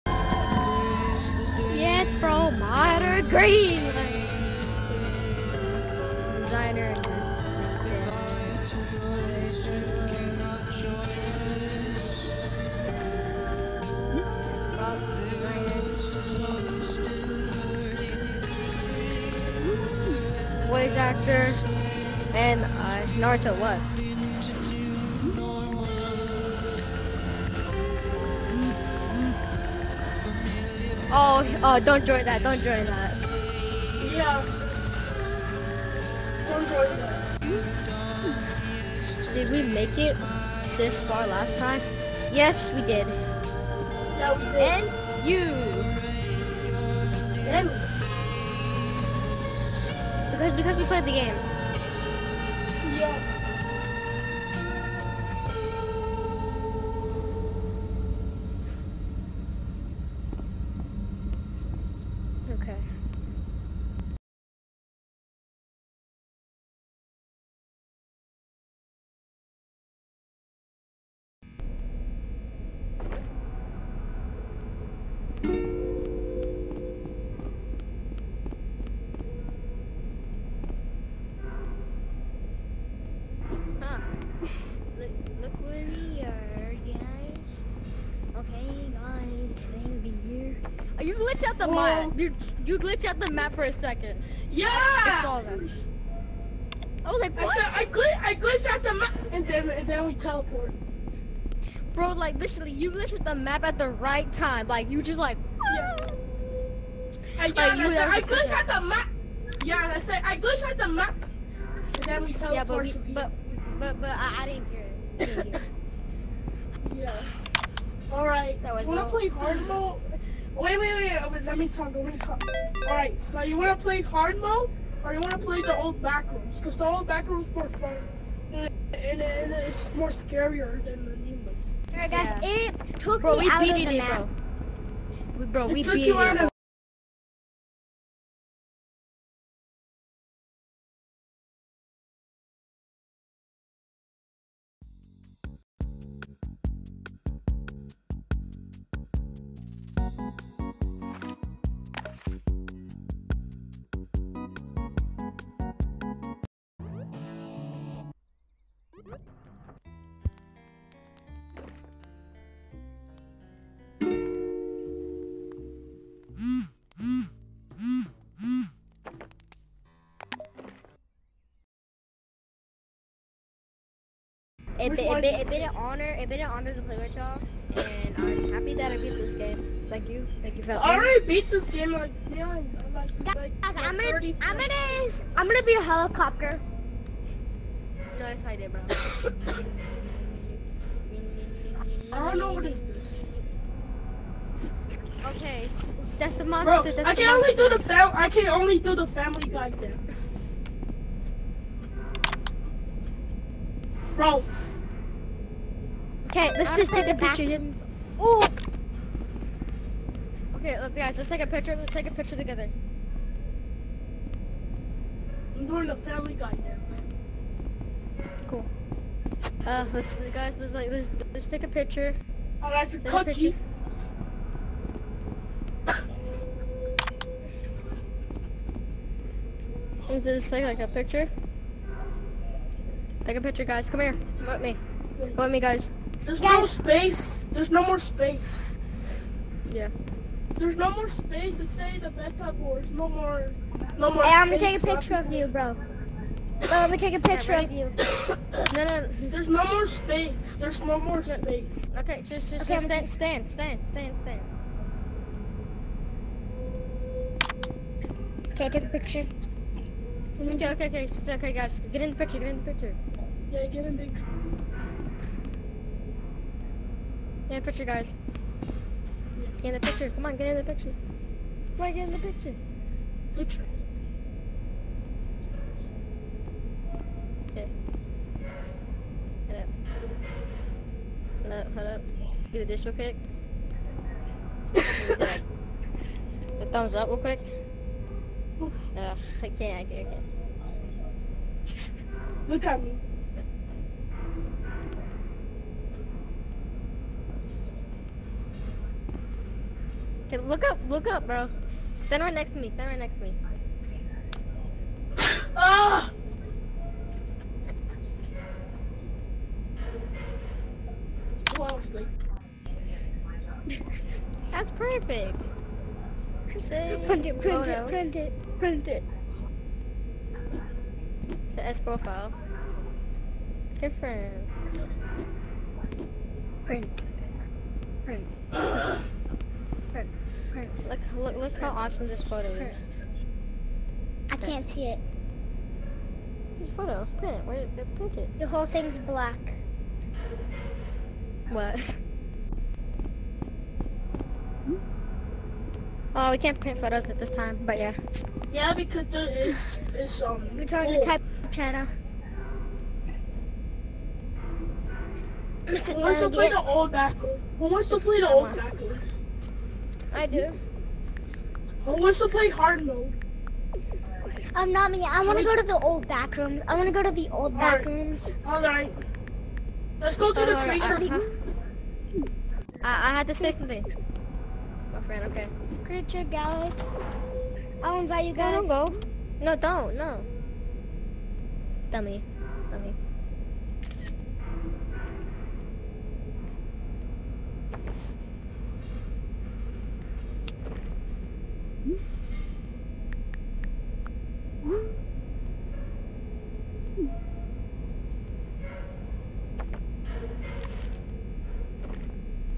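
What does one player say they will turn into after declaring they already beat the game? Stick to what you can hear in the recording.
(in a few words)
a helicopter.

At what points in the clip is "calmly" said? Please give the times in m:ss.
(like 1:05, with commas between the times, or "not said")
not said.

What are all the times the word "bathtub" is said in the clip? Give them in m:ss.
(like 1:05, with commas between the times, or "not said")
4:02.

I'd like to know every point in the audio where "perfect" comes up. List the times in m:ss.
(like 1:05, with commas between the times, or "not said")
5:14.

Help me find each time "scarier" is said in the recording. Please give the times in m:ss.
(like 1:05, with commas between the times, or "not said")
2:10.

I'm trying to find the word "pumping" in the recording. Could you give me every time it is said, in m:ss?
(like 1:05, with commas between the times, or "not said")
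not said.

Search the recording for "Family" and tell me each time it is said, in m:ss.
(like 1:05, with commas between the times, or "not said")
3:19, 3:35.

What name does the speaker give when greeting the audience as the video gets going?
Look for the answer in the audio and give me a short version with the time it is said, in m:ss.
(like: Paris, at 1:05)
Fang, at 1:29.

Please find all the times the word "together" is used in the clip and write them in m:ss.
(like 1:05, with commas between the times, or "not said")
3:32.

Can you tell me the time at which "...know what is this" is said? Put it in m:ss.
3:12.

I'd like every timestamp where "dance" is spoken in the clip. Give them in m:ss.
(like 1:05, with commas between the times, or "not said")
3:19, 3:36.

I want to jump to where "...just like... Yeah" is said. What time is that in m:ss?
1:45.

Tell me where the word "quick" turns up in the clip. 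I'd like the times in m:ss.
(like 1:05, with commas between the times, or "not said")
4:42, 4:47.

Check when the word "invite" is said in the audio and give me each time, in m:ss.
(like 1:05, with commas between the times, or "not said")
6:18.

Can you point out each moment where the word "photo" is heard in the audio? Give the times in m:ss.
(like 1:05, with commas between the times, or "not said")
5:17, 5:32, 5:36, 5:46.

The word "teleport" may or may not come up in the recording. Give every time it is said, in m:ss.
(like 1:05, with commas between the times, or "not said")
1:40, 1:52.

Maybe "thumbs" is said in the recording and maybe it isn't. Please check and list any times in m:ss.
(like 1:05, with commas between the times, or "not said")
4:46.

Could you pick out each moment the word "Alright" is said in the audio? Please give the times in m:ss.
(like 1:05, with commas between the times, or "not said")
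1:58, 2:02, 2:11.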